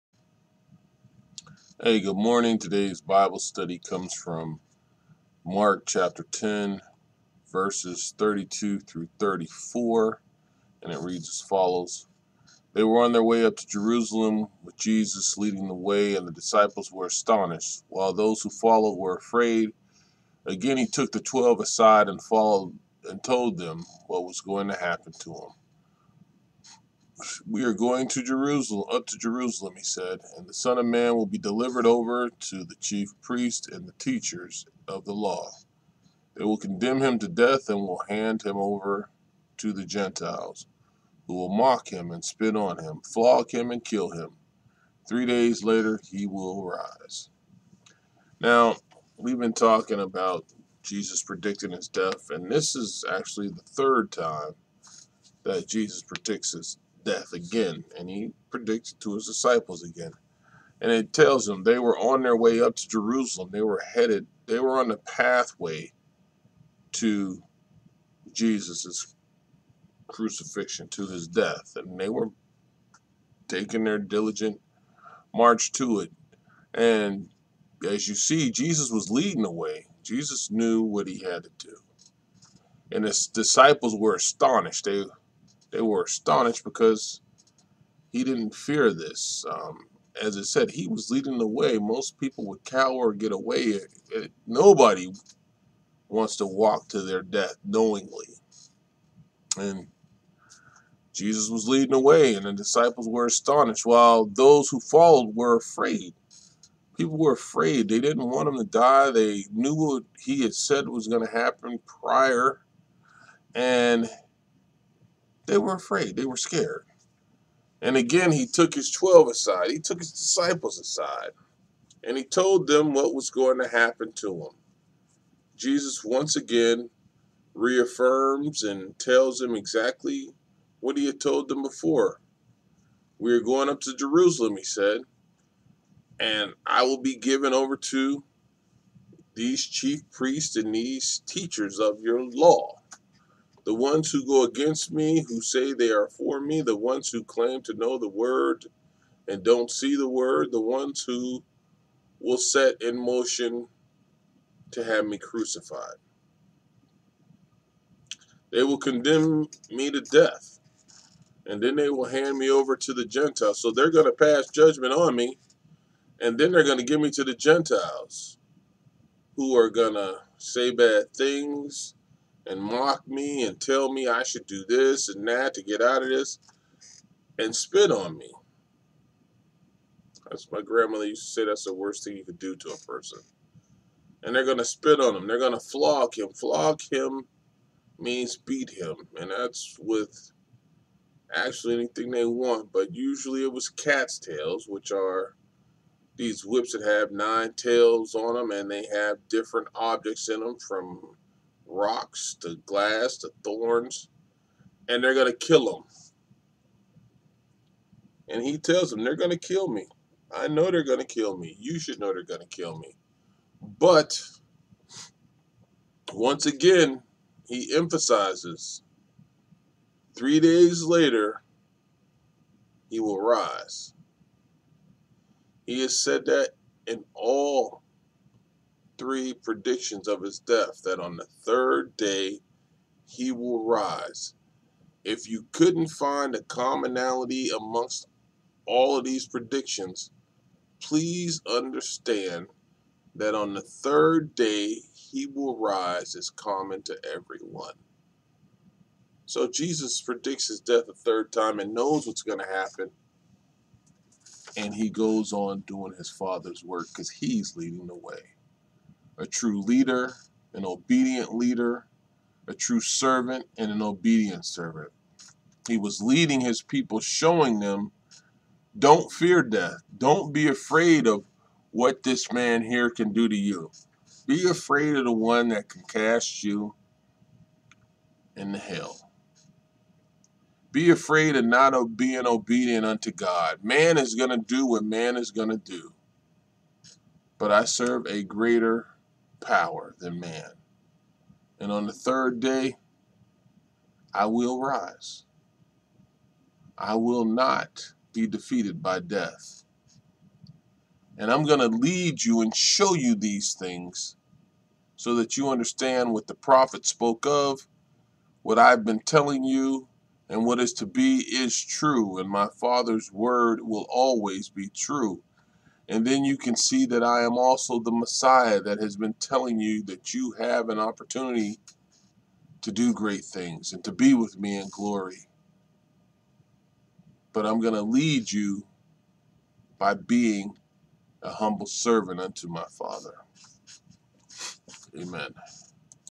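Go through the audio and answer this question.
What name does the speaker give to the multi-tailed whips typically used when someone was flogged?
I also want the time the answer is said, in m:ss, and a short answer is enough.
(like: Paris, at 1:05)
Cat's tails, at 3:13.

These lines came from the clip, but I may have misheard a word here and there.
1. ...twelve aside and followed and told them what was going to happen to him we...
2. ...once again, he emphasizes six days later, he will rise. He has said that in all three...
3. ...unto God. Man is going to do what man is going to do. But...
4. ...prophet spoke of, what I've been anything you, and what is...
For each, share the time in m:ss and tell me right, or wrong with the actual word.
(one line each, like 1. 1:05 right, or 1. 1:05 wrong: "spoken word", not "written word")
1. 0:21 right
2. 3:36 wrong: "three", not "six"
3. 4:42 right
4. 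5:06 wrong: "telling", not "anything".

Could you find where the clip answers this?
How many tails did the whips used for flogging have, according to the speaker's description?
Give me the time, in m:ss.
3:17.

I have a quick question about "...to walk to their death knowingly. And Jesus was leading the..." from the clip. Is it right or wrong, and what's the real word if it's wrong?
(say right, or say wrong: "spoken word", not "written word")
right.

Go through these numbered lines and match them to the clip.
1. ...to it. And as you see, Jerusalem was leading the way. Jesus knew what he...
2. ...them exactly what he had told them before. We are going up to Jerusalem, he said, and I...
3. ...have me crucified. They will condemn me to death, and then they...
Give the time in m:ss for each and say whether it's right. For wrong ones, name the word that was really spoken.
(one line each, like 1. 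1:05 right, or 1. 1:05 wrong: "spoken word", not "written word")
1. 1:15 wrong: "Jesus", not "Jerusalem"
2. 2:09 right
3. 2:34 right.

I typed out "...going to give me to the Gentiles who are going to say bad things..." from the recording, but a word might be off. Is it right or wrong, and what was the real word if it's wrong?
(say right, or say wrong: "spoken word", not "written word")
right.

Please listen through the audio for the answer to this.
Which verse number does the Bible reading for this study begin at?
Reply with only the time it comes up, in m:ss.
0:08.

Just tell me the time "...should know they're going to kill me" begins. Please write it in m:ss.
3:31.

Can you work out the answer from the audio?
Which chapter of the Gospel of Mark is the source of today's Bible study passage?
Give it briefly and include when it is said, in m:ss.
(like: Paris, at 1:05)
Chapter 10, at 0:05.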